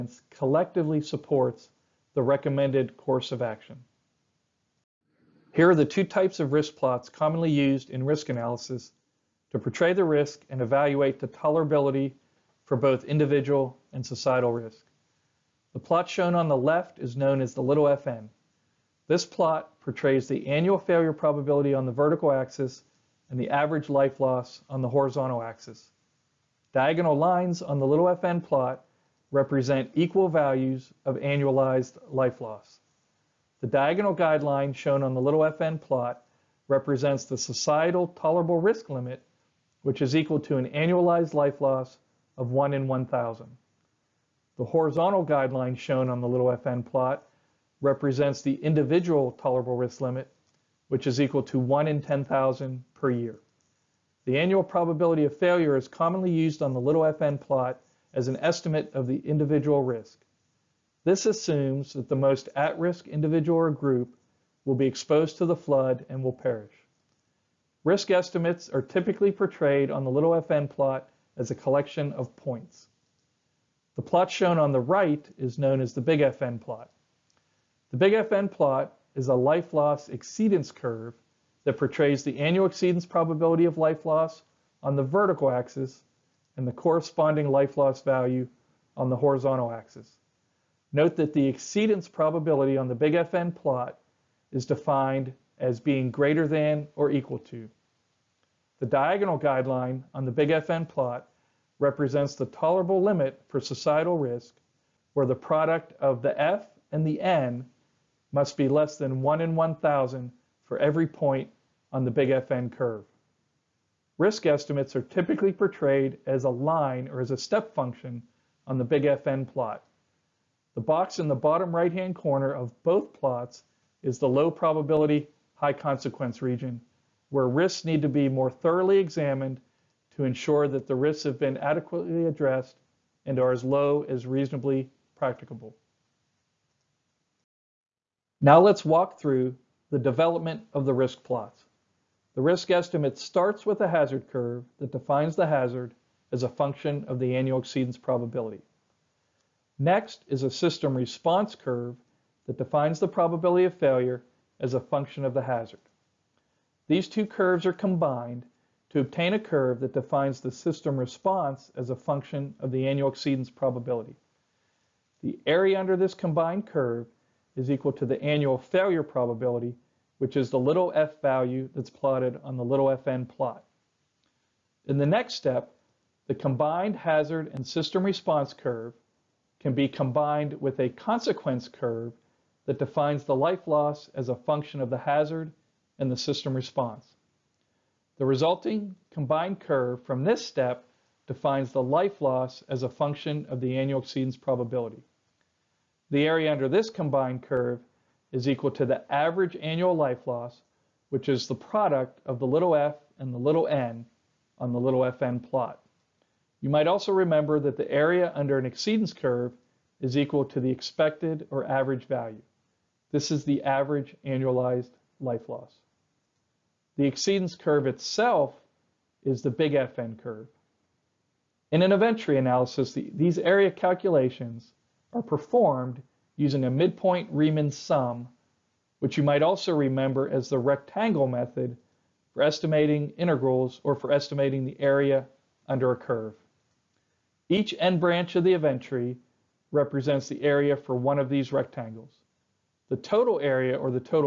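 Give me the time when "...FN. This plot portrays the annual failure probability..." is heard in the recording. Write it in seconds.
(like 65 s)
17 s.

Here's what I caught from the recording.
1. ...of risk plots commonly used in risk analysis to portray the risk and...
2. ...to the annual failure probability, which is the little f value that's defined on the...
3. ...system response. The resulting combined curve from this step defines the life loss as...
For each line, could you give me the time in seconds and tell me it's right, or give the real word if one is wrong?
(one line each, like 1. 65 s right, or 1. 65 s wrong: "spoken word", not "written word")
1. 6 s right
2. 167 s wrong: "plotted", not "defined"
3. 186 s right.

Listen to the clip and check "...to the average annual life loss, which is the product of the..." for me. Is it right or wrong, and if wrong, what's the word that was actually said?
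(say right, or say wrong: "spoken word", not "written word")
right.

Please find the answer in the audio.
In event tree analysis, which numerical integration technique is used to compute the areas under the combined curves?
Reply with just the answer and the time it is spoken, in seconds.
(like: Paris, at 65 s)
midpoint Riemann sum, at 226 s.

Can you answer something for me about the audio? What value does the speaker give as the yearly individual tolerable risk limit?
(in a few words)
1 in 10,000.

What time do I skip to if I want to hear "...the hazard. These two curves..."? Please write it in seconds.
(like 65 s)
155 s.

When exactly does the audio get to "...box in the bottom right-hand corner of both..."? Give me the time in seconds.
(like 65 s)
120 s.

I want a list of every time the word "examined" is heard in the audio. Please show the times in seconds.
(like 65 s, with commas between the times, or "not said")
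128 s.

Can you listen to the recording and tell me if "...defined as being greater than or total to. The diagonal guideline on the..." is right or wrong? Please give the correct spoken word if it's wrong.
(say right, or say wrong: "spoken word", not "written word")
wrong: "equal", not "total".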